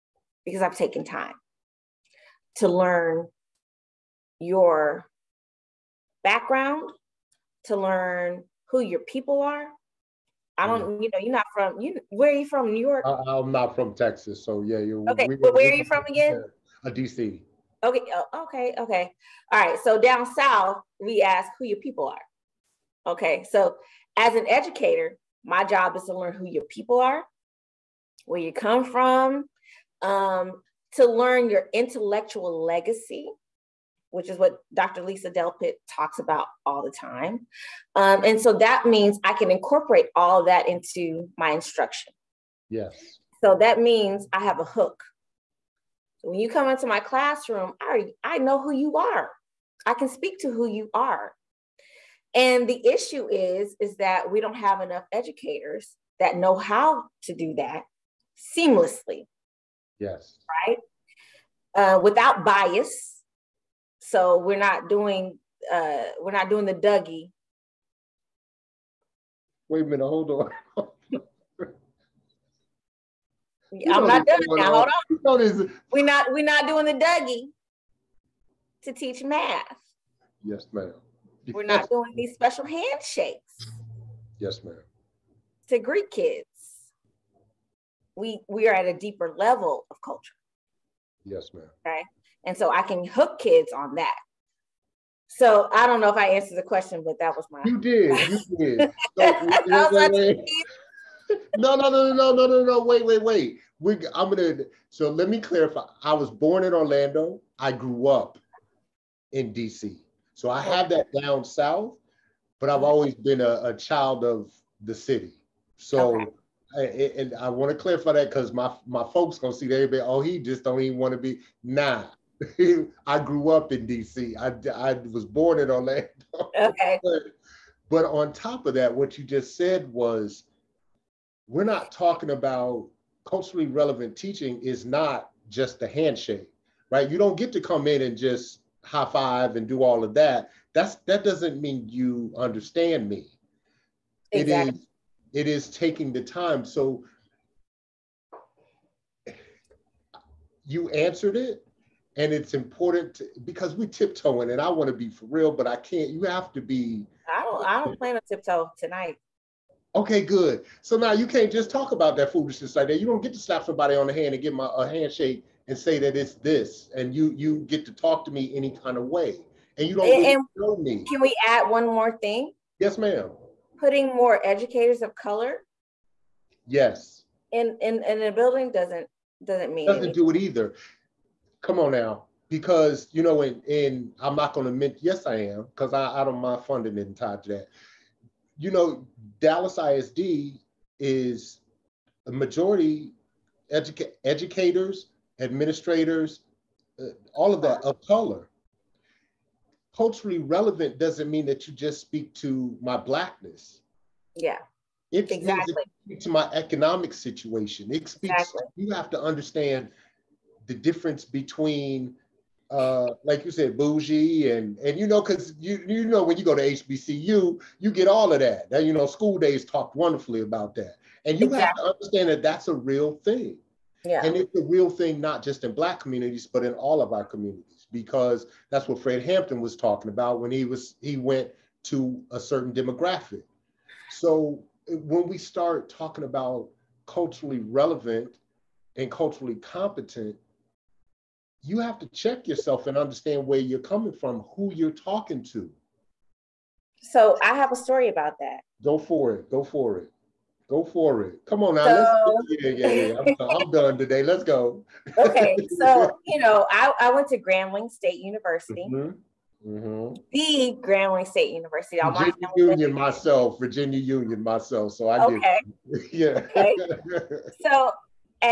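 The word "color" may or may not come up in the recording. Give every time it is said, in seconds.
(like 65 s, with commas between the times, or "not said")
175 s, 198 s.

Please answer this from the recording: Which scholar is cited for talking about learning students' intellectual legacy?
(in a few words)
Dr. Lisa Delpit.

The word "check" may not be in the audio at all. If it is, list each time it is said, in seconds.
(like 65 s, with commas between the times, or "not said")
242 s.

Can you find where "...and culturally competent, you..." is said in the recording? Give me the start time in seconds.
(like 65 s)
238 s.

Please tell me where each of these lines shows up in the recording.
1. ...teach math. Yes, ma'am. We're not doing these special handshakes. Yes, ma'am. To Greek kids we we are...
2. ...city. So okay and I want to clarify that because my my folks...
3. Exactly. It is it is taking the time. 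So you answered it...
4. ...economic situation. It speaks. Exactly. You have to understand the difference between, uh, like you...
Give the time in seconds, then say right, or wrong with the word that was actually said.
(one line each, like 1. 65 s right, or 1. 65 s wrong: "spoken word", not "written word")
1. 78 s right
2. 114 s right
3. 144 s right
4. 206 s right.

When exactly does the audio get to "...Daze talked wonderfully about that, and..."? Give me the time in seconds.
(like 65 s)
219 s.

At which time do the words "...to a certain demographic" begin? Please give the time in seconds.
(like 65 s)
231 s.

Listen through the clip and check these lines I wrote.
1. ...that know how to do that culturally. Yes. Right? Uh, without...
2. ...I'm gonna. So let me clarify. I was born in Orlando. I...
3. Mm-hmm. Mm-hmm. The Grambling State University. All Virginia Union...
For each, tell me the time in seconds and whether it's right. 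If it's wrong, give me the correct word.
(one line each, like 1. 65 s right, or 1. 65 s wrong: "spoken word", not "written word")
1. 56 s wrong: "seamlessly", not "culturally"
2. 104 s right
3. 258 s right.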